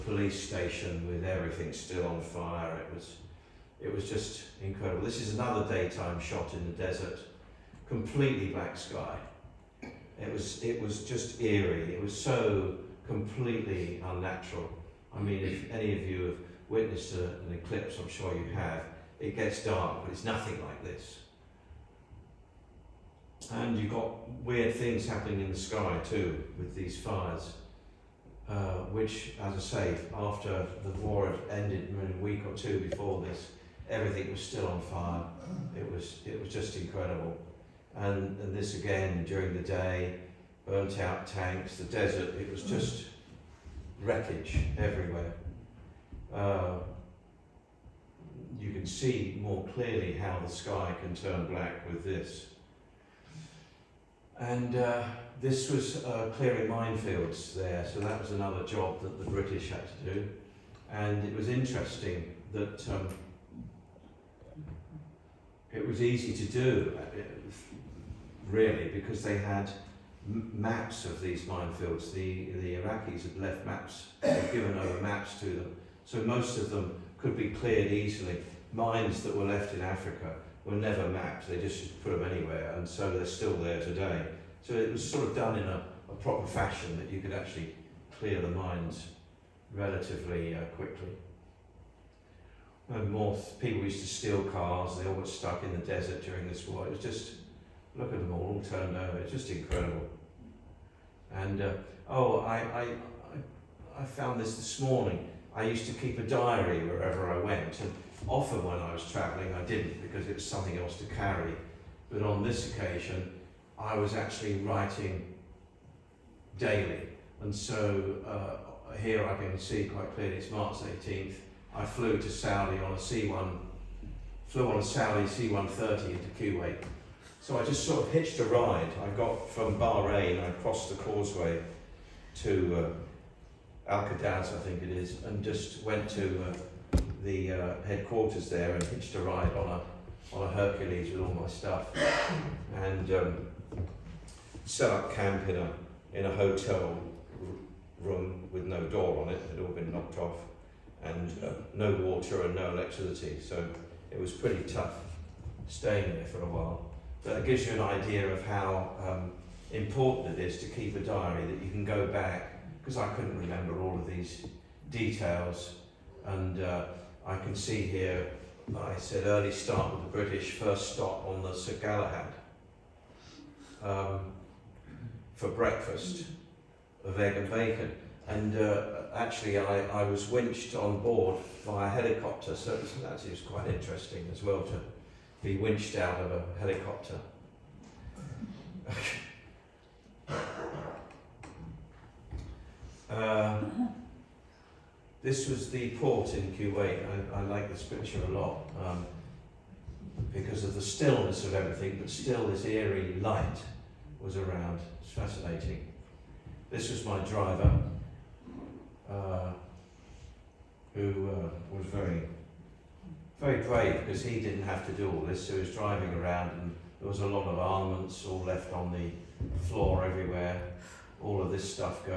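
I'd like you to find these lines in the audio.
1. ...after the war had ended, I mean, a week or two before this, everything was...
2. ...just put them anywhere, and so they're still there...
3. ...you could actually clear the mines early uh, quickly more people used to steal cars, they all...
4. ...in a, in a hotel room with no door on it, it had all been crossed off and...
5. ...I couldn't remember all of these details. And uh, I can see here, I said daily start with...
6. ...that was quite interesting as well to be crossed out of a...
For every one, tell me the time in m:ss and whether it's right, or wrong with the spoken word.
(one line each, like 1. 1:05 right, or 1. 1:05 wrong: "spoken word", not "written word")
1. 0:30 right
2. 1:21 right
3. 1:27 wrong: "relatively", not "early"
4. 2:25 wrong: "knocked", not "crossed"
5. 2:42 wrong: "early", not "daily"
6. 3:02 wrong: "winched", not "crossed".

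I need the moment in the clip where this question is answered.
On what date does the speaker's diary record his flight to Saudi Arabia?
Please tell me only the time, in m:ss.
2:00.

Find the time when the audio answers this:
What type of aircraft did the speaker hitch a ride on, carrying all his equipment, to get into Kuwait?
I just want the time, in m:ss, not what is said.
2:20.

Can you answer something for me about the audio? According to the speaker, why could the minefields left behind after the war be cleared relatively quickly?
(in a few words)
They had maps.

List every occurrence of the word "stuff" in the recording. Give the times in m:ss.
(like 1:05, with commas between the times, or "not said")
2:21.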